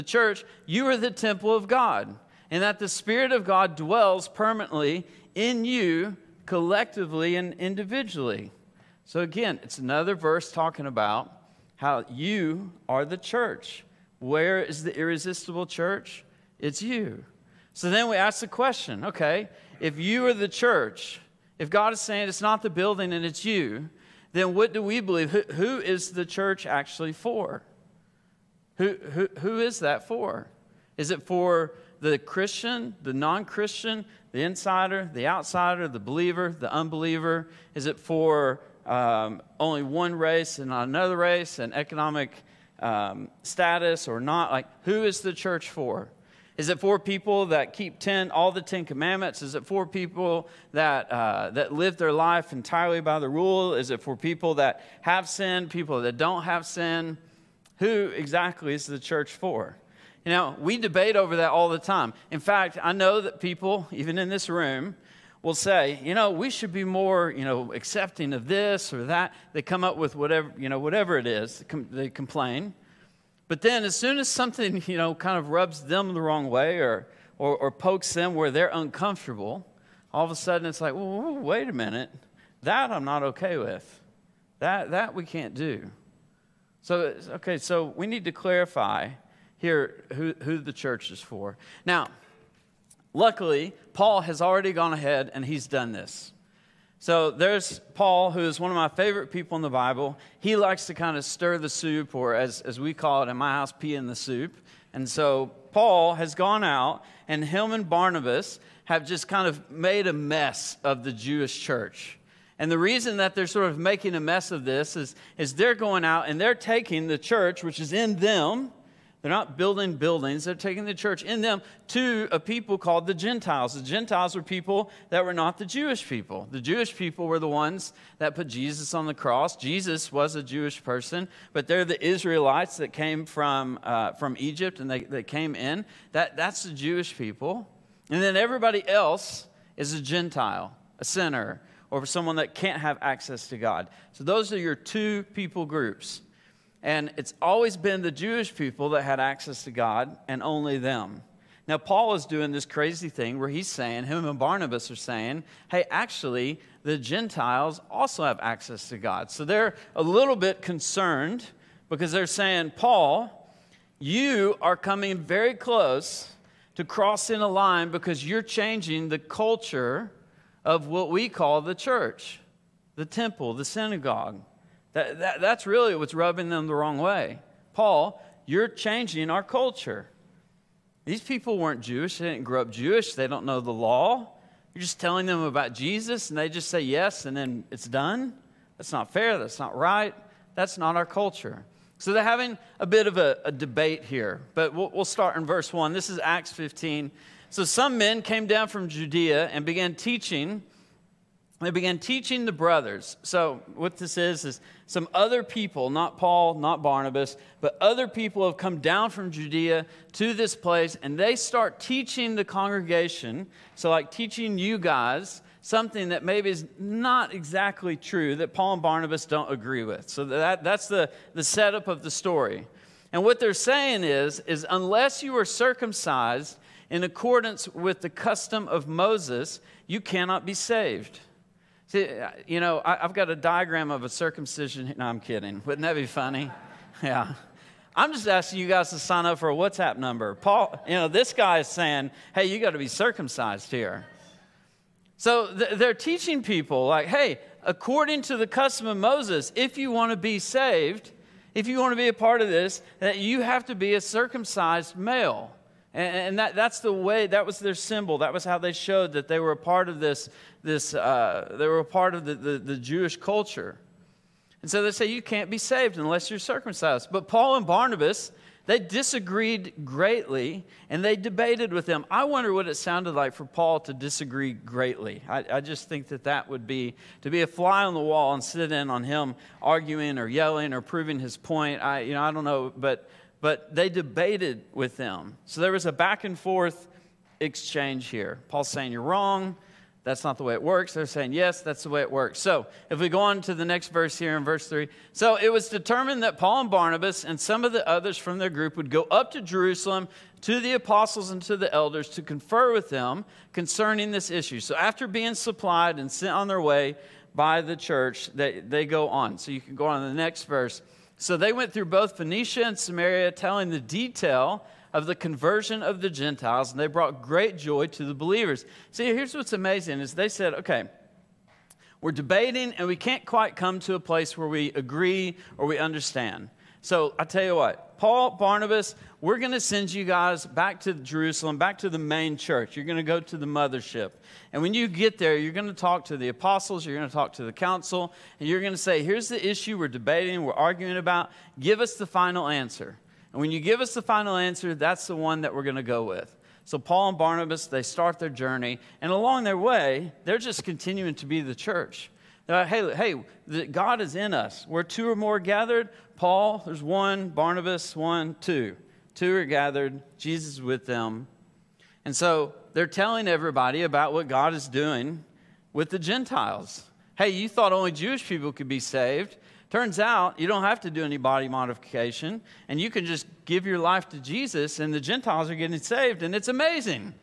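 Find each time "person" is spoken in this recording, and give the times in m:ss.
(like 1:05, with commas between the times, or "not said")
2:10.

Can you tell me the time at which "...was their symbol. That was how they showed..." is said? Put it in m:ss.
4:17.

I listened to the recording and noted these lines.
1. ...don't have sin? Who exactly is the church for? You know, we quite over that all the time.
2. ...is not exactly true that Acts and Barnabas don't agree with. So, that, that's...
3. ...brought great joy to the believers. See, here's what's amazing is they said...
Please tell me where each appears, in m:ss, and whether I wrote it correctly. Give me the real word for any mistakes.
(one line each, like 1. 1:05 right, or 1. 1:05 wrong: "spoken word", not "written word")
1. 0:56 wrong: "debate", not "quite"
2. 3:36 wrong: "Paul", not "Acts"
3. 5:16 right.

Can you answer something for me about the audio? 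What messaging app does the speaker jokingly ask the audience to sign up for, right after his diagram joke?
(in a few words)
WhatsApp.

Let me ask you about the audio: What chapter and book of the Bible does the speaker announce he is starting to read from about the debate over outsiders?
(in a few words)
Acts 15.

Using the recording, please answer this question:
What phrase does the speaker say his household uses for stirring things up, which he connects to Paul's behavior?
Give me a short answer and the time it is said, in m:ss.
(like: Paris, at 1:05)
pee in the soup, at 1:43.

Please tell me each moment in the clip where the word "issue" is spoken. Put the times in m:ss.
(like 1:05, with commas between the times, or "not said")
5:04, 5:39.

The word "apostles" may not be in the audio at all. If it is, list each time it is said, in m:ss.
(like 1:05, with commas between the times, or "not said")
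5:00, 5:36.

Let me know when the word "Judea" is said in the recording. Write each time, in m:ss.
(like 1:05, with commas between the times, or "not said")
3:18, 3:29.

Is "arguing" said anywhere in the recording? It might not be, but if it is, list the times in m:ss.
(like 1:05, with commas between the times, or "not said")
4:39, 5:40.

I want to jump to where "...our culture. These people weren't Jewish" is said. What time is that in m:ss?
2:59.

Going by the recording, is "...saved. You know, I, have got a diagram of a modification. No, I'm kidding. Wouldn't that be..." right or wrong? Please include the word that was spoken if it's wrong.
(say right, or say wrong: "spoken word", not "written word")
wrong: "circumcision", not "modification".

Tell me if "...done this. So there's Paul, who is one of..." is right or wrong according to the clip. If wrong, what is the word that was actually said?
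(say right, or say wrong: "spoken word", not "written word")
right.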